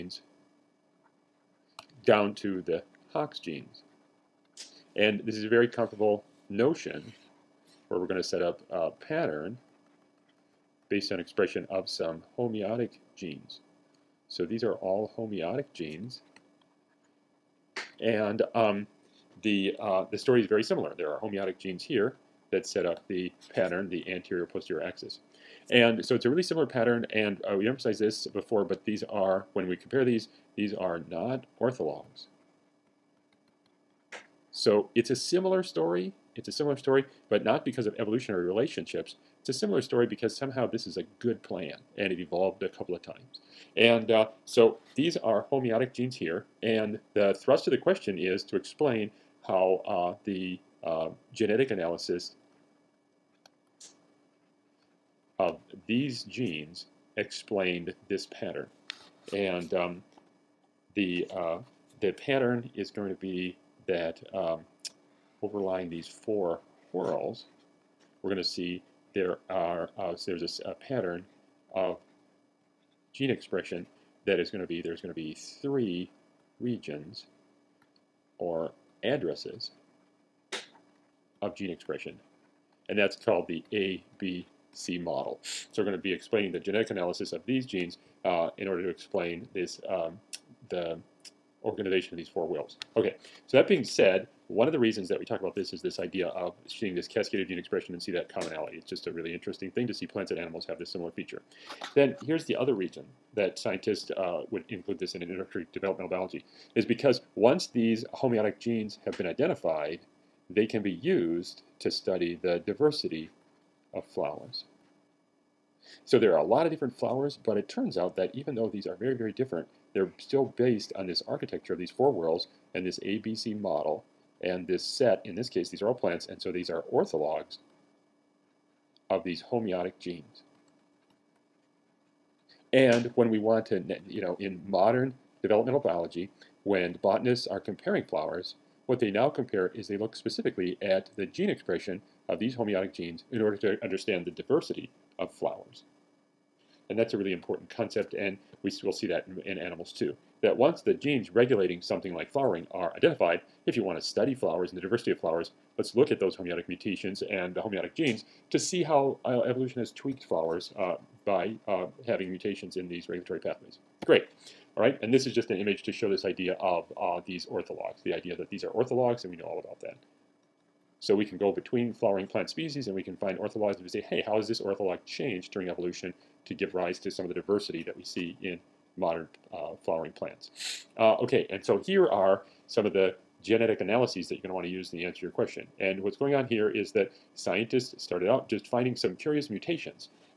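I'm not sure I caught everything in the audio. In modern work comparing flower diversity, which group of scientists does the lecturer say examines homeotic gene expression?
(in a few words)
Botanists.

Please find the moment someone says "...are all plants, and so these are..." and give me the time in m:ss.
2:05.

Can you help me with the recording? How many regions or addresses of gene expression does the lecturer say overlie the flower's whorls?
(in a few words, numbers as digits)
3.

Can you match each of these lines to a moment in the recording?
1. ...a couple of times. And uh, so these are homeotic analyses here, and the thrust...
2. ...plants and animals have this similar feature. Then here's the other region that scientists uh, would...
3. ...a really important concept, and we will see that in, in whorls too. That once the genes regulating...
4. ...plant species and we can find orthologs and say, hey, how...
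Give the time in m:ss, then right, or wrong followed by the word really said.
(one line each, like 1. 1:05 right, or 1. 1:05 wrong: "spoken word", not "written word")
1. 0:42 wrong: "genes", not "analyses"
2. 1:40 right
3. 2:27 wrong: "animals", not "whorls"
4. 2:52 right.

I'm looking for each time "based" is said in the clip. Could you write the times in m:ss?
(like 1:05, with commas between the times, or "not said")
0:10, 2:00.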